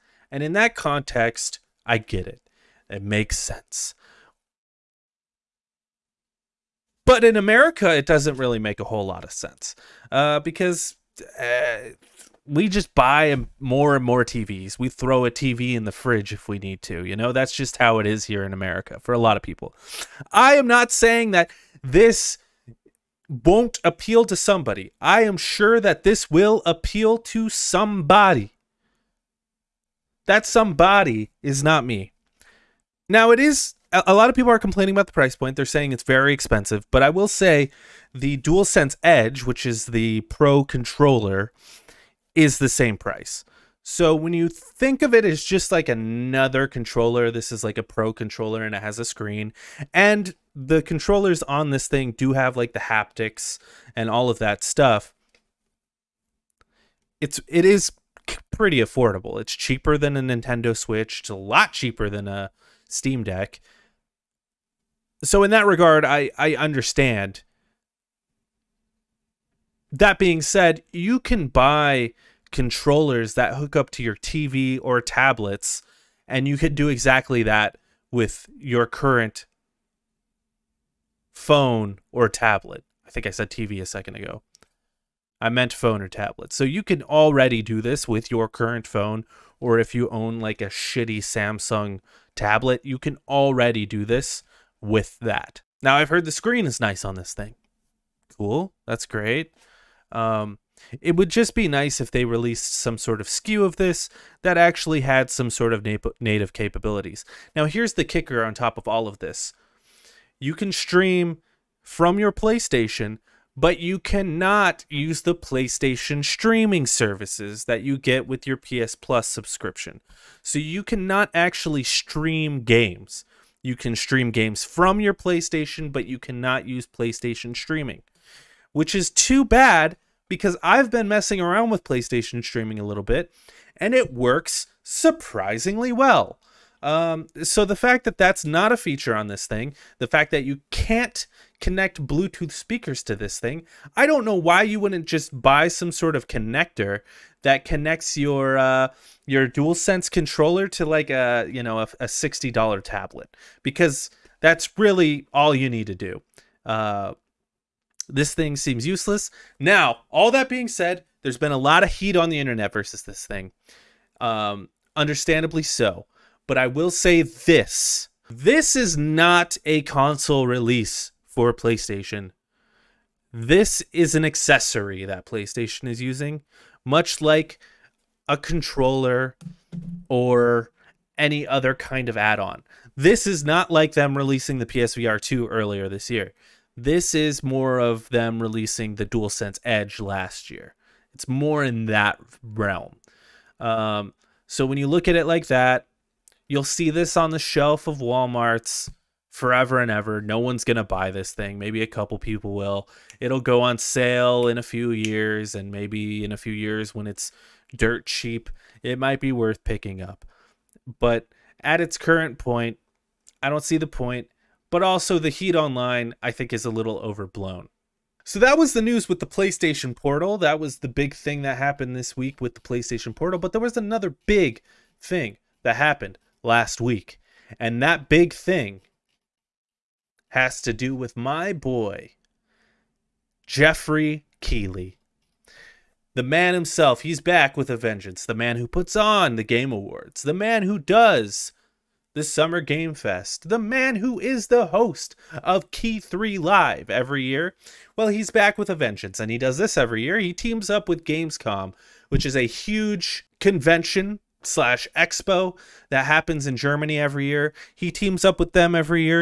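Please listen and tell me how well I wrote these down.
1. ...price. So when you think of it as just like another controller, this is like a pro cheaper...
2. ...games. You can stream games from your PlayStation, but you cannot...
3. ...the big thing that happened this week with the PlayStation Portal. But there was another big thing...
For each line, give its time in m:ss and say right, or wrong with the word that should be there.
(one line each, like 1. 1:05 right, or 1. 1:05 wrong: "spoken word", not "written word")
1. 0:42 wrong: "controller", not "cheaper"
2. 2:02 right
3. 3:40 right.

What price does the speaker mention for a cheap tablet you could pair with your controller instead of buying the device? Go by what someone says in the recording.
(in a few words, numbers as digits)
$60.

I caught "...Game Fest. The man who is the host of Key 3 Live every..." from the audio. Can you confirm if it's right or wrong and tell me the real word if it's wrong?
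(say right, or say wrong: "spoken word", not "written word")
right.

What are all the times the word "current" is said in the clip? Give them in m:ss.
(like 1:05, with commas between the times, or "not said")
1:18, 1:28, 3:31.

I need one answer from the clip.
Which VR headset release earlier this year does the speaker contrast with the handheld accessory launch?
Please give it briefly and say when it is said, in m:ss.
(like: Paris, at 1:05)
PSVR 2, at 3:04.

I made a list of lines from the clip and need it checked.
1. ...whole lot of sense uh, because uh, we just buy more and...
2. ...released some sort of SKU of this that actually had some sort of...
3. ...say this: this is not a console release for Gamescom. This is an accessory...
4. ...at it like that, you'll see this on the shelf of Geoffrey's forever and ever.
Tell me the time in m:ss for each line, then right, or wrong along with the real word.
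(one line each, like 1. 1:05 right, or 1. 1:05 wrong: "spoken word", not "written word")
1. 0:08 right
2. 1:42 right
3. 2:46 wrong: "PlayStation", not "Gamescom"
4. 3:15 wrong: "Walmart", not "Geoffrey".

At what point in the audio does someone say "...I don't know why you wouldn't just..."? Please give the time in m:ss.
2:23.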